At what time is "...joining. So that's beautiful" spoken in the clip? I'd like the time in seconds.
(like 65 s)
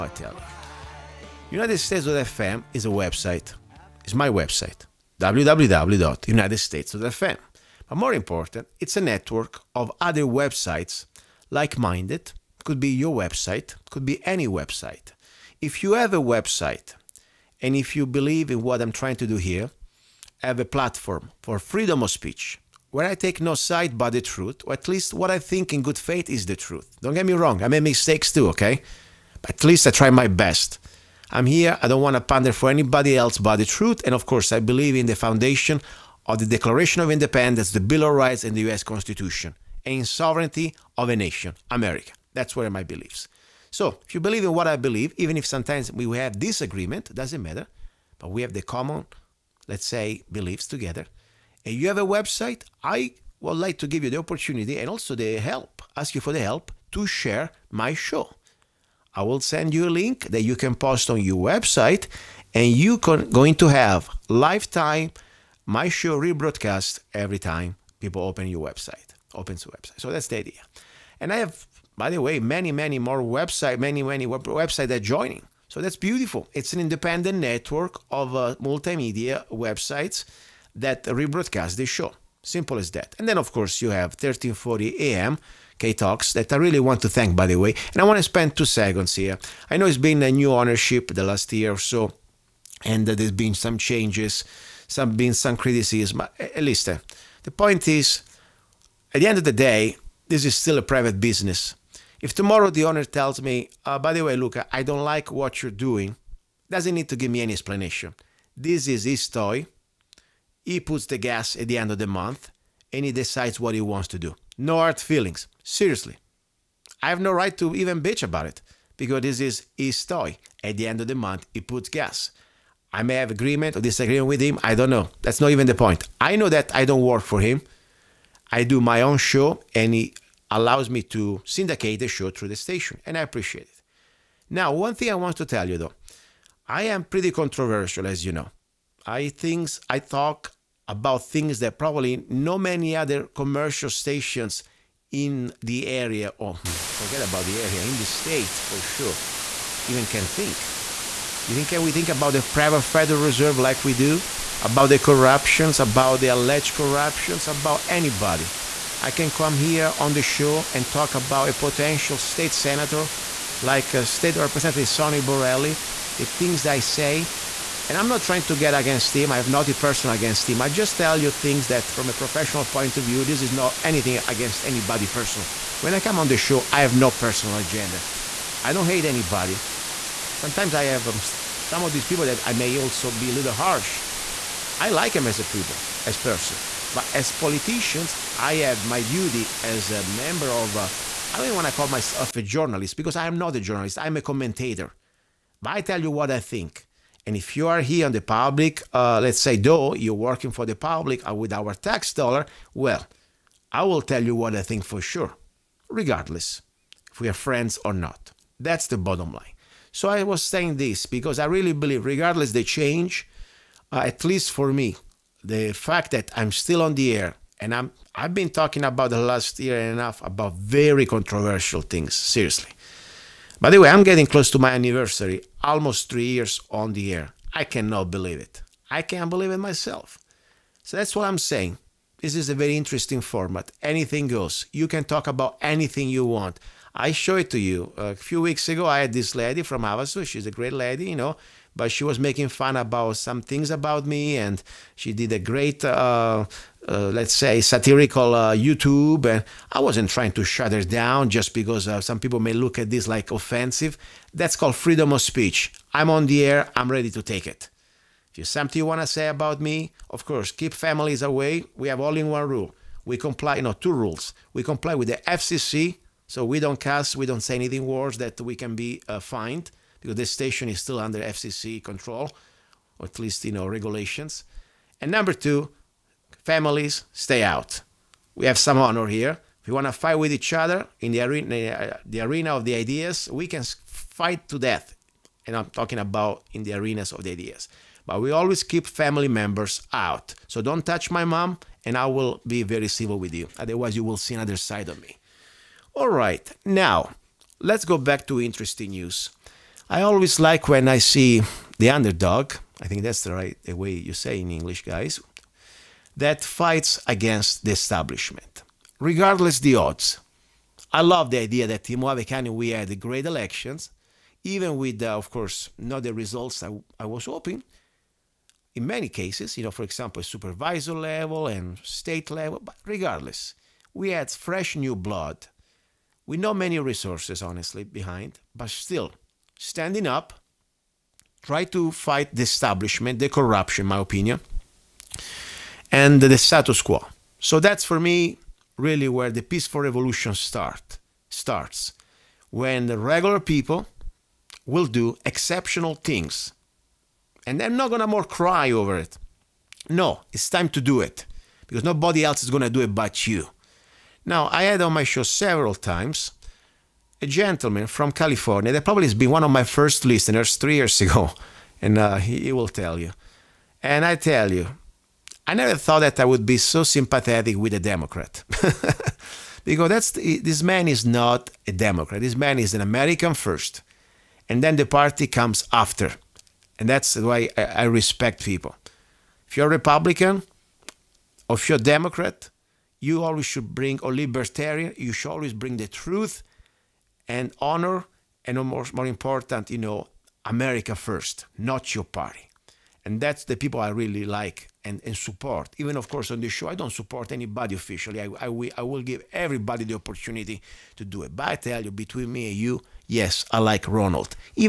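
75 s.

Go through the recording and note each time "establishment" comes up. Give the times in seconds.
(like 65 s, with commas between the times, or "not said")
307 s, 332 s.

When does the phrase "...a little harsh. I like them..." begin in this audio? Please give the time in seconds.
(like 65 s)
183 s.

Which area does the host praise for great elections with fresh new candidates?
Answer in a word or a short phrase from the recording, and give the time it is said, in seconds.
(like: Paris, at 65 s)
Mohave, at 311 s.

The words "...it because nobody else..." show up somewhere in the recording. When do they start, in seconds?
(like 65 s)
350 s.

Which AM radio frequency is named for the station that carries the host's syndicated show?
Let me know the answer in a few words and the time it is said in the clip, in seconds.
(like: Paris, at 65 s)
1340, at 84 s.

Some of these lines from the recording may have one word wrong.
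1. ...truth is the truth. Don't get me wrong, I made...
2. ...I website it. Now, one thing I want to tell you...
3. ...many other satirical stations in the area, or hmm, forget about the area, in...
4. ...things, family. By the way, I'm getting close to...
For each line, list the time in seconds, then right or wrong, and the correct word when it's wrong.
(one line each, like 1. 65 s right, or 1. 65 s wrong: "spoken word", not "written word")
1. 25 s wrong: "faith", not "truth"
2. 133 s wrong: "appreciate", not "website"
3. 142 s wrong: "commercial", not "satirical"
4. 221 s wrong: "seriously", not "family".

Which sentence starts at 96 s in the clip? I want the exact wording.
At least uh, the point is, at the end of the day, this is still a private business.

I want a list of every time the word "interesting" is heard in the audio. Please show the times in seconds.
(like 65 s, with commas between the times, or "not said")
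232 s, 298 s.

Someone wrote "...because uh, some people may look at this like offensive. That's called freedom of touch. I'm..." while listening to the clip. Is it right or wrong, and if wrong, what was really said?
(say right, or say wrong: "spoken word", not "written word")
wrong: "speech", not "touch".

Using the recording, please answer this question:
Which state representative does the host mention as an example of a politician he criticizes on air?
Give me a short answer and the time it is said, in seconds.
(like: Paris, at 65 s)
Sonny Borrelli, at 164 s.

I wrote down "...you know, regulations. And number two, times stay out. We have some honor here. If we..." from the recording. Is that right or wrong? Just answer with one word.
wrong.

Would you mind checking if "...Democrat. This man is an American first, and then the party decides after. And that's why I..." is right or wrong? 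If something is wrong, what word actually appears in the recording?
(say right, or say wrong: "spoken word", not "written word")
wrong: "comes", not "decides".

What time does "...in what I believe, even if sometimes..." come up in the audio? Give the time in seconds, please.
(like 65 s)
44 s.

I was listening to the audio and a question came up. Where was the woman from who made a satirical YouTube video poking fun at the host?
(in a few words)
Havasu.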